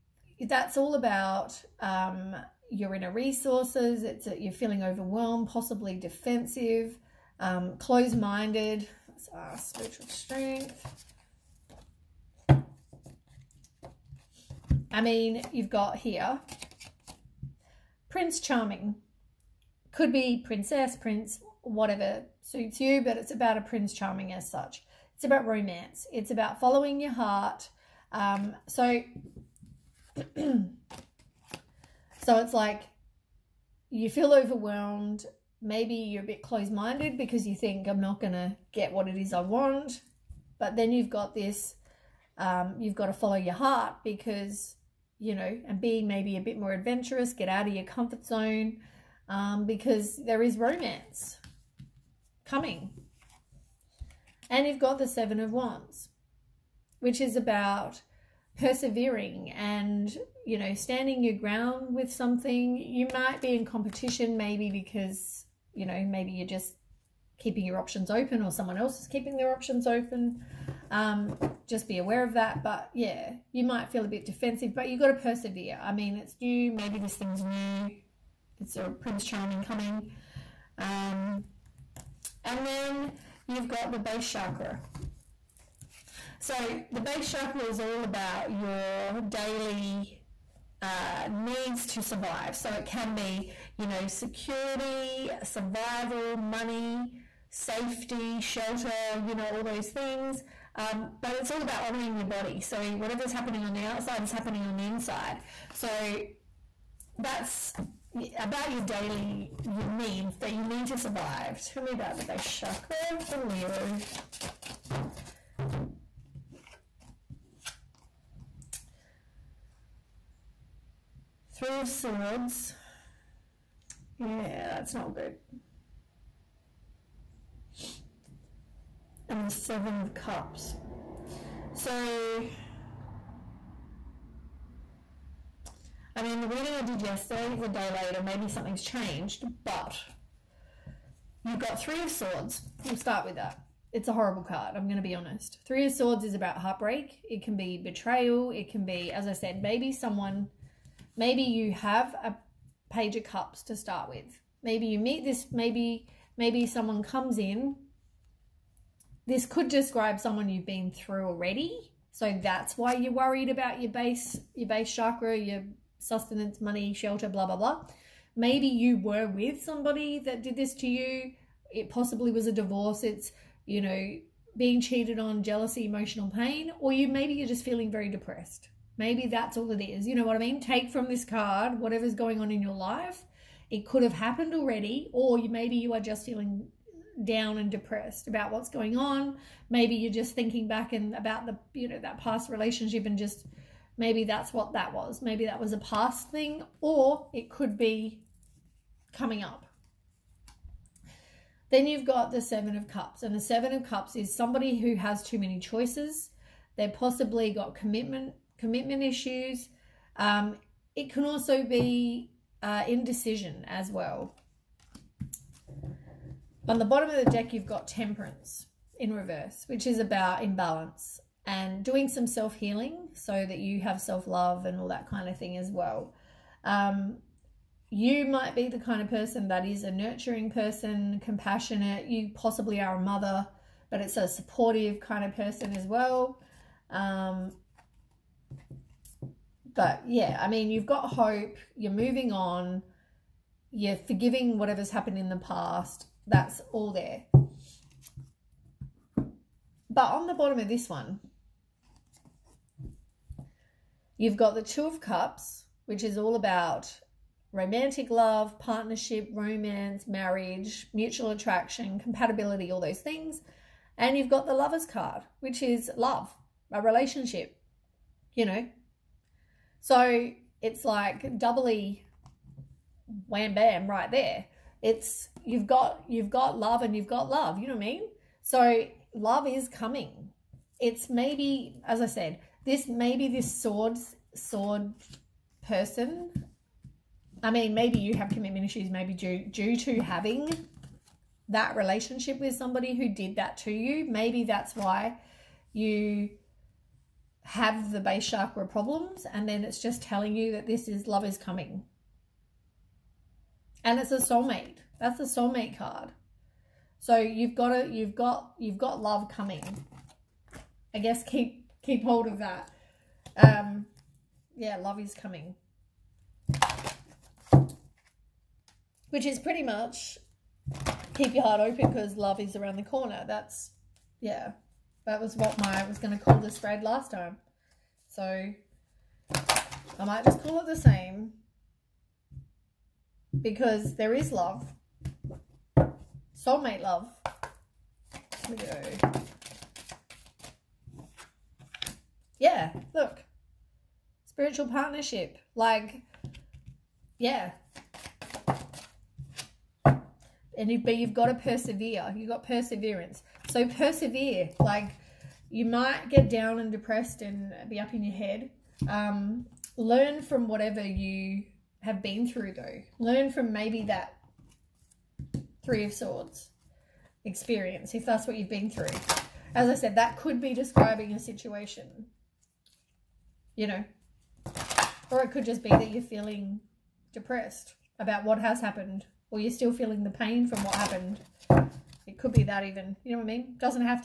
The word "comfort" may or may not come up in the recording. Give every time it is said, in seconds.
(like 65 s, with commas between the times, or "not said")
47 s.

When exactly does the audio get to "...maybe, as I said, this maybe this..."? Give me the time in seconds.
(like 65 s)
281 s.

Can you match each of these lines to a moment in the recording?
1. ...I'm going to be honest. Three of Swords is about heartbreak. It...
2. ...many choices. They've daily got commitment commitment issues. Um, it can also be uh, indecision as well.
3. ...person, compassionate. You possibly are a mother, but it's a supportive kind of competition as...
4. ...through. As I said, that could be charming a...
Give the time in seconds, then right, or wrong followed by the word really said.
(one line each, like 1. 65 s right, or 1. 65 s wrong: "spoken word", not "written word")
1. 144 s right
2. 205 s wrong: "possibly", not "daily"
3. 230 s wrong: "person", not "competition"
4. 368 s wrong: "describing", not "charming".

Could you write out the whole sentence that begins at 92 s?
So it can be, you know, security, survival, money, safety, shelter, you know, all those things.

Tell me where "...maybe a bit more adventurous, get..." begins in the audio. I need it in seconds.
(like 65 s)
46 s.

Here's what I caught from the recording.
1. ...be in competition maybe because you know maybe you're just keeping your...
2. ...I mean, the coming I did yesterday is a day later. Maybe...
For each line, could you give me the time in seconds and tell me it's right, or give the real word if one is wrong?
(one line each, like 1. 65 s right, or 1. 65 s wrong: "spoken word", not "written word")
1. 63 s right
2. 136 s wrong: "reading", not "coming".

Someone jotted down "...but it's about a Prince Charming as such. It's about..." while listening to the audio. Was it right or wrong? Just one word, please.
right.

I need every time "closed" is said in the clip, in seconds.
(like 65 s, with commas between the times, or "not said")
7 s, 36 s.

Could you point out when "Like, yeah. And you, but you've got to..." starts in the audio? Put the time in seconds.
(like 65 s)
345 s.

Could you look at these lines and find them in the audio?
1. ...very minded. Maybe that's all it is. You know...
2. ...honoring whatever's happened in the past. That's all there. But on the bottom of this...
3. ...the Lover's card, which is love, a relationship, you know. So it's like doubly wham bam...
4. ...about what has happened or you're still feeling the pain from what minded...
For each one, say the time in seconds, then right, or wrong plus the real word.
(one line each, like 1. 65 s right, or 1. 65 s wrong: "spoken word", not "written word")
1. 177 s wrong: "depressed", not "minded"
2. 243 s wrong: "forgiving", not "honoring"
3. 264 s right
4. 378 s wrong: "happened", not "minded".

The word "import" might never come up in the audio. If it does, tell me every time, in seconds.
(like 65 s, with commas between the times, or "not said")
not said.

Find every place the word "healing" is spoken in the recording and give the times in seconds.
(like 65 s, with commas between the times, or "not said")
222 s.